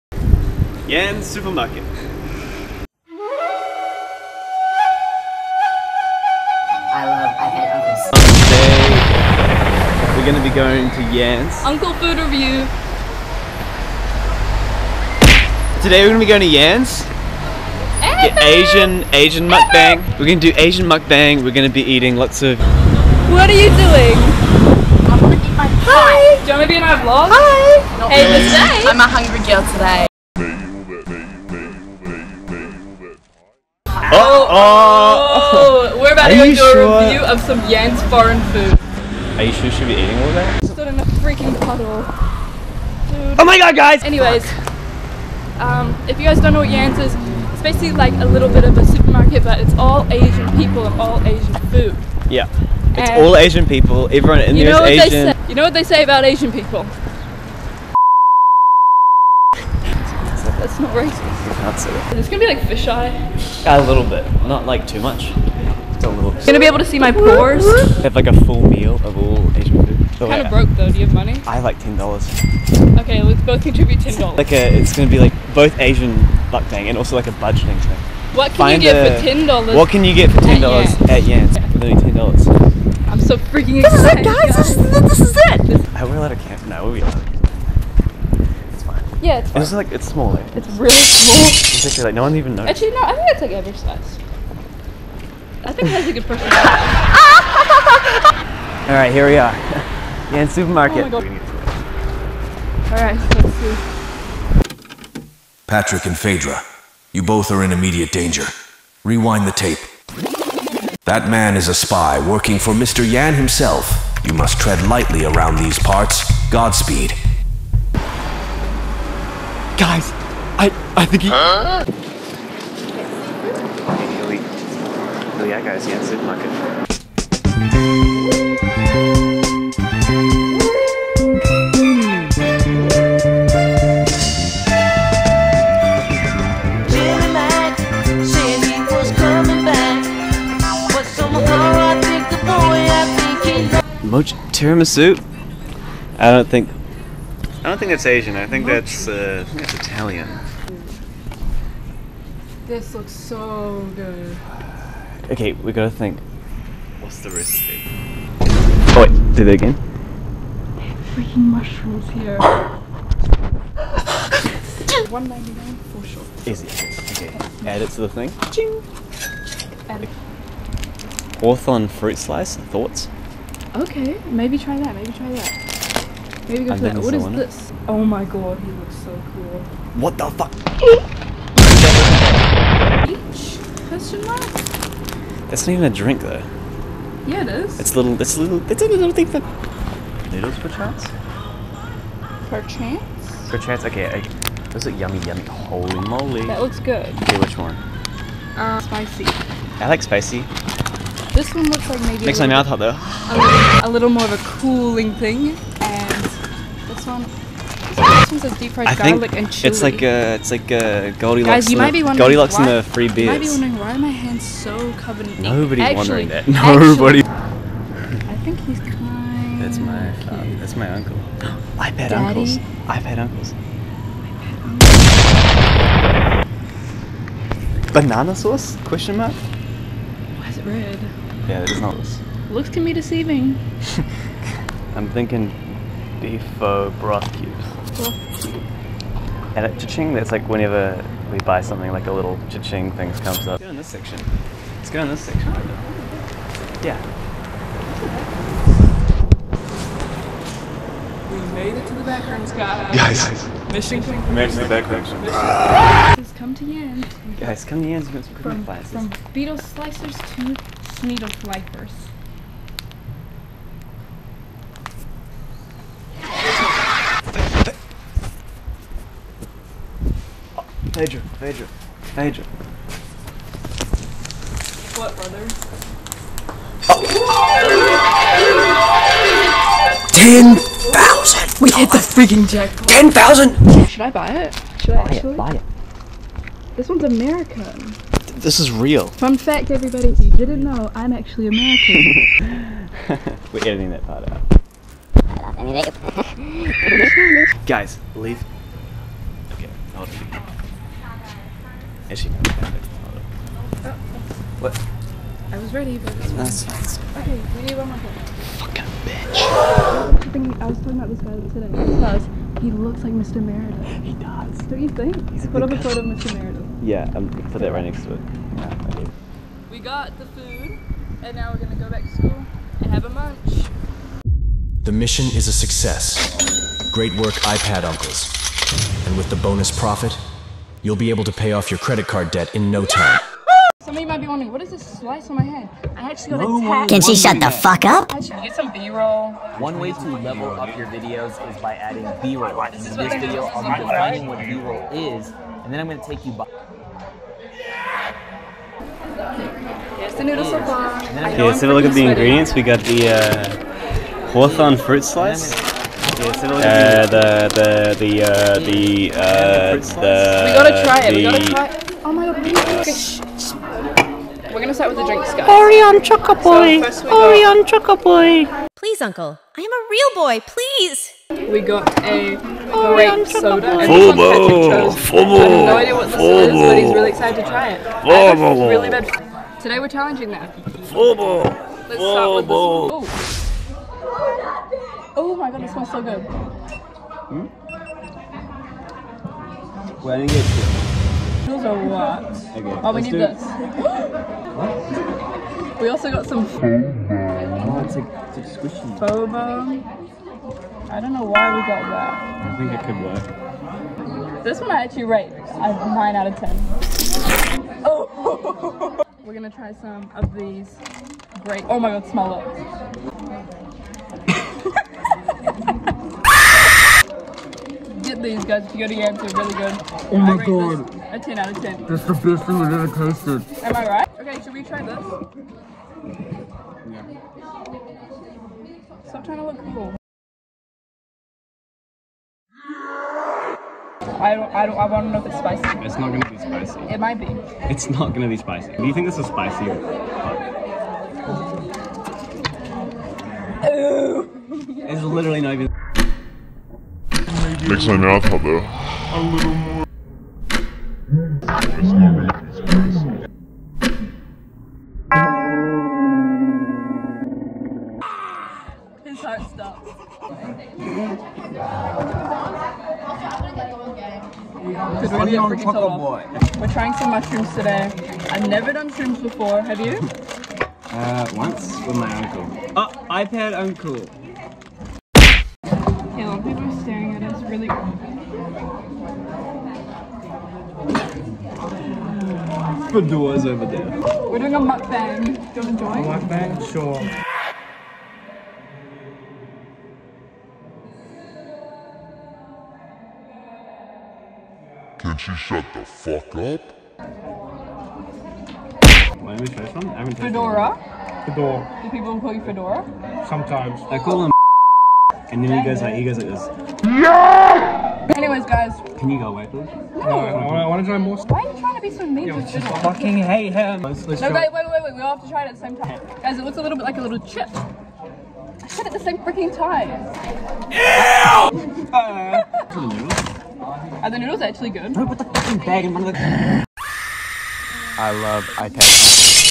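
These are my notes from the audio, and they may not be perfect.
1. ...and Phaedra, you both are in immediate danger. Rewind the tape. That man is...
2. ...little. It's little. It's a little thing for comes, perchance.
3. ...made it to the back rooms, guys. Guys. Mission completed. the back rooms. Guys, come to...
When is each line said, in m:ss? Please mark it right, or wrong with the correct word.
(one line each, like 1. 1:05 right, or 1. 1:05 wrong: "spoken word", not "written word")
1. 1:46 right
2. 3:07 wrong: "noodles", not "comes"
3. 4:11 right.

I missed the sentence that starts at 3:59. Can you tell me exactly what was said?
And at cha-ching, that's like whenever we buy something, like a little cha-ching thing comes up.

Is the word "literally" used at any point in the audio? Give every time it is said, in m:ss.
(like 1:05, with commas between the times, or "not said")
1:21, 7:25.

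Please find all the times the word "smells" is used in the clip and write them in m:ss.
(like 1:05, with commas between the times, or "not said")
6:25, 6:52.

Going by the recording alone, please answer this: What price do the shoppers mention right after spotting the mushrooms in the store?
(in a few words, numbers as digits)
199.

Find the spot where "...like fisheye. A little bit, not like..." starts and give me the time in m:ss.
1:02.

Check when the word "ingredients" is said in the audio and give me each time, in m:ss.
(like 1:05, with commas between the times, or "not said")
5:52.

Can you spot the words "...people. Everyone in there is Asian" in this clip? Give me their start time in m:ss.
0:53.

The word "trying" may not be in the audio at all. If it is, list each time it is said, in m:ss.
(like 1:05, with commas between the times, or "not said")
7:09, 7:46, 8:31.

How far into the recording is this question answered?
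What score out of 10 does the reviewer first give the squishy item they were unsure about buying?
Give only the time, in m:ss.
6:45.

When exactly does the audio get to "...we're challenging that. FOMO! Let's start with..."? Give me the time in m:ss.
6:19.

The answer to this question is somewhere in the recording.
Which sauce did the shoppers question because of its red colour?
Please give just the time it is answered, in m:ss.
3:47.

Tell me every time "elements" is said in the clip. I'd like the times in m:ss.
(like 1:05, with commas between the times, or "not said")
not said.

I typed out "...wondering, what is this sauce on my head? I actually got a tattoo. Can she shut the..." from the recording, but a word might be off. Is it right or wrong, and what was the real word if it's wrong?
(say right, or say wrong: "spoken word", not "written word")
wrong: "slice", not "sauce".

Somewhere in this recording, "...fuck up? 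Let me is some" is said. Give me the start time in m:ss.
8:15.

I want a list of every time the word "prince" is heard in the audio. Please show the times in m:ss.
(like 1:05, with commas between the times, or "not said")
not said.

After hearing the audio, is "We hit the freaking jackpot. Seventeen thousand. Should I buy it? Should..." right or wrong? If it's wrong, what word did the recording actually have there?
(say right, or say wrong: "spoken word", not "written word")
wrong: "Ten", not "Seventeen".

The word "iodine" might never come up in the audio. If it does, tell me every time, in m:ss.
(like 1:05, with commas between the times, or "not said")
not said.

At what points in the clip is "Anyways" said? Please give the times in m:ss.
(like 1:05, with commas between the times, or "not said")
0:44, 8:28.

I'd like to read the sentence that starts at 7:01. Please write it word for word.
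That's the best thing I've ever tasted.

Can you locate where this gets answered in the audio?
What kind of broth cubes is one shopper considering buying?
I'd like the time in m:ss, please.
3:56.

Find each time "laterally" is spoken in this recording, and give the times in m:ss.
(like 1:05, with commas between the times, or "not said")
not said.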